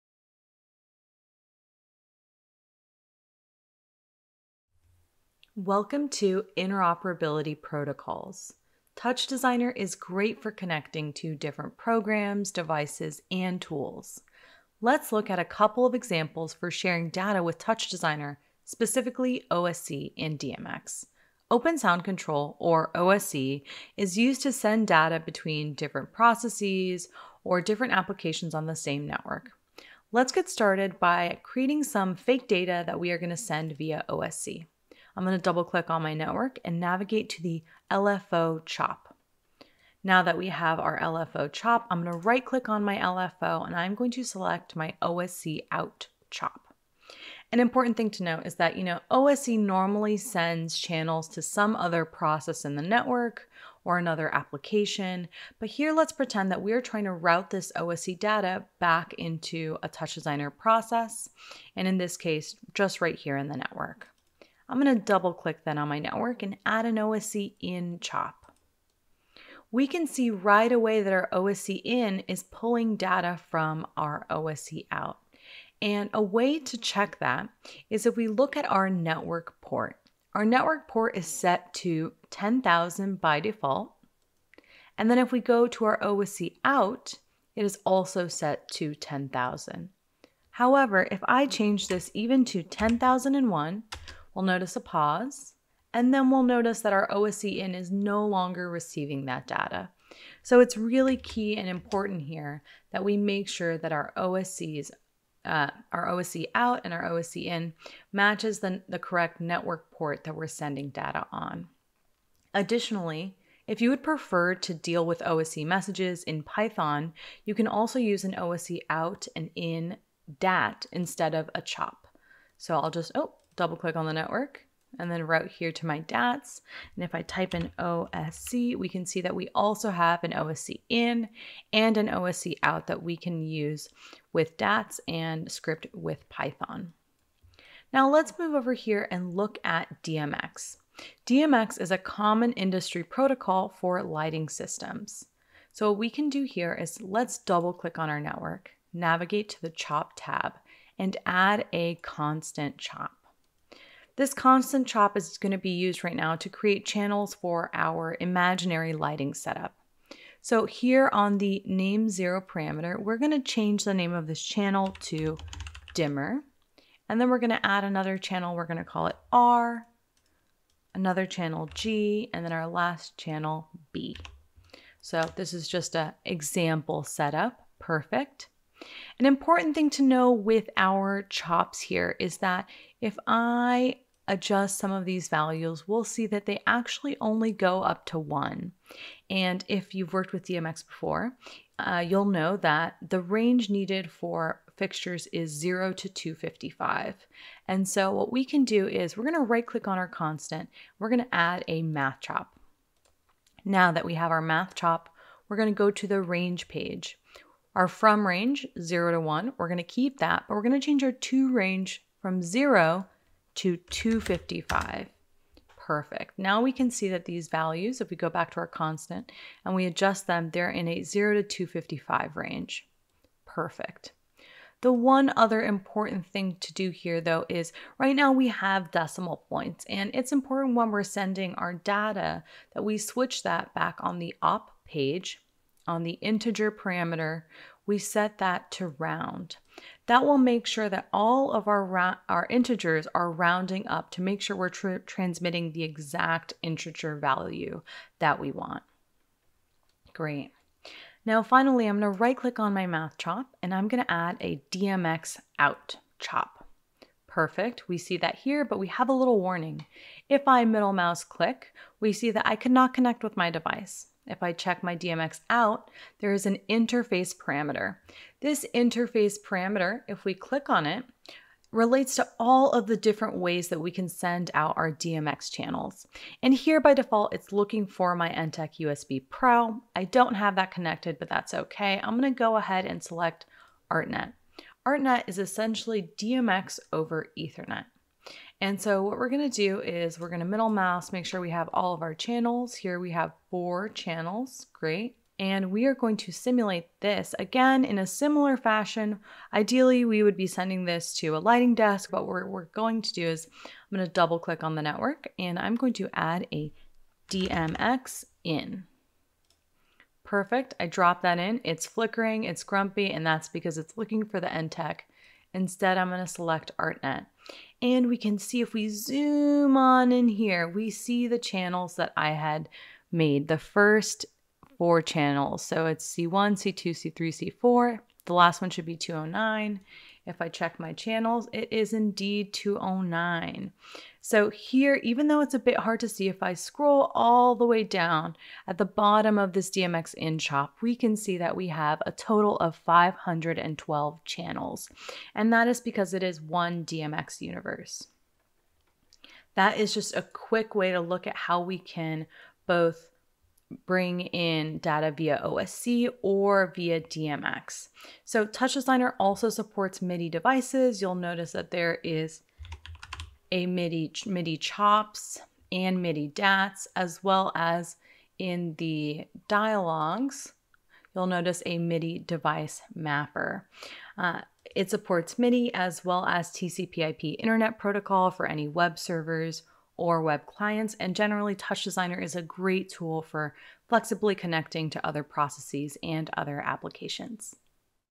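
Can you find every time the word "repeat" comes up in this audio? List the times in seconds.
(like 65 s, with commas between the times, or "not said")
not said.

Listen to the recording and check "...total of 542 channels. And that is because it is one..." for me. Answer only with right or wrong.
wrong.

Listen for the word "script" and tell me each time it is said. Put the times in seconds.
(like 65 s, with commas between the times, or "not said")
135 s.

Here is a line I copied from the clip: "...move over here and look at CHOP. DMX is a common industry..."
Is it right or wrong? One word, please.
wrong.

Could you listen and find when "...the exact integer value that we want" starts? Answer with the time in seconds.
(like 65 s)
245 s.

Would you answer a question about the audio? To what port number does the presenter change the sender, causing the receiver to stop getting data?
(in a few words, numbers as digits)
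10,001.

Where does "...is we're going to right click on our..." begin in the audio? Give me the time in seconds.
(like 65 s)
198 s.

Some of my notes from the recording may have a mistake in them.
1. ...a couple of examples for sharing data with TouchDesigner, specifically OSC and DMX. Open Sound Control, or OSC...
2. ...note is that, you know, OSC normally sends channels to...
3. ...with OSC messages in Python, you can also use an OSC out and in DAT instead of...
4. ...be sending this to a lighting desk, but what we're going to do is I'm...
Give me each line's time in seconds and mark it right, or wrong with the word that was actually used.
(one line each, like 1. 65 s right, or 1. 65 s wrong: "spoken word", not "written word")
1. 15 s right
2. 48 s right
3. 115 s right
4. 300 s right.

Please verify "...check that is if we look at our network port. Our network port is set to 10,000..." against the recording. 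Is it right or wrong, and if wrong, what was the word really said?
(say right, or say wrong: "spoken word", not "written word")
right.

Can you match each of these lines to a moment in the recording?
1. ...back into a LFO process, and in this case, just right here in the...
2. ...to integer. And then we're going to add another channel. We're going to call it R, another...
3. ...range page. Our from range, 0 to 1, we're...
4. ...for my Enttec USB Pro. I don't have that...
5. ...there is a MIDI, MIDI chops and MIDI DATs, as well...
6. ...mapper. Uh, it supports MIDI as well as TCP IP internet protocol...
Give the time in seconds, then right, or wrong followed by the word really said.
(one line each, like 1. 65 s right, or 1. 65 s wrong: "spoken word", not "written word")
1. 58 s wrong: "TouchDesigner", not "LFO"
2. 165 s wrong: "dimmer", not "integer"
3. 206 s right
4. 277 s right
5. 361 s right
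6. 372 s right.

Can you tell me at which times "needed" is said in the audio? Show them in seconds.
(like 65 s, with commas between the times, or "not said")
193 s.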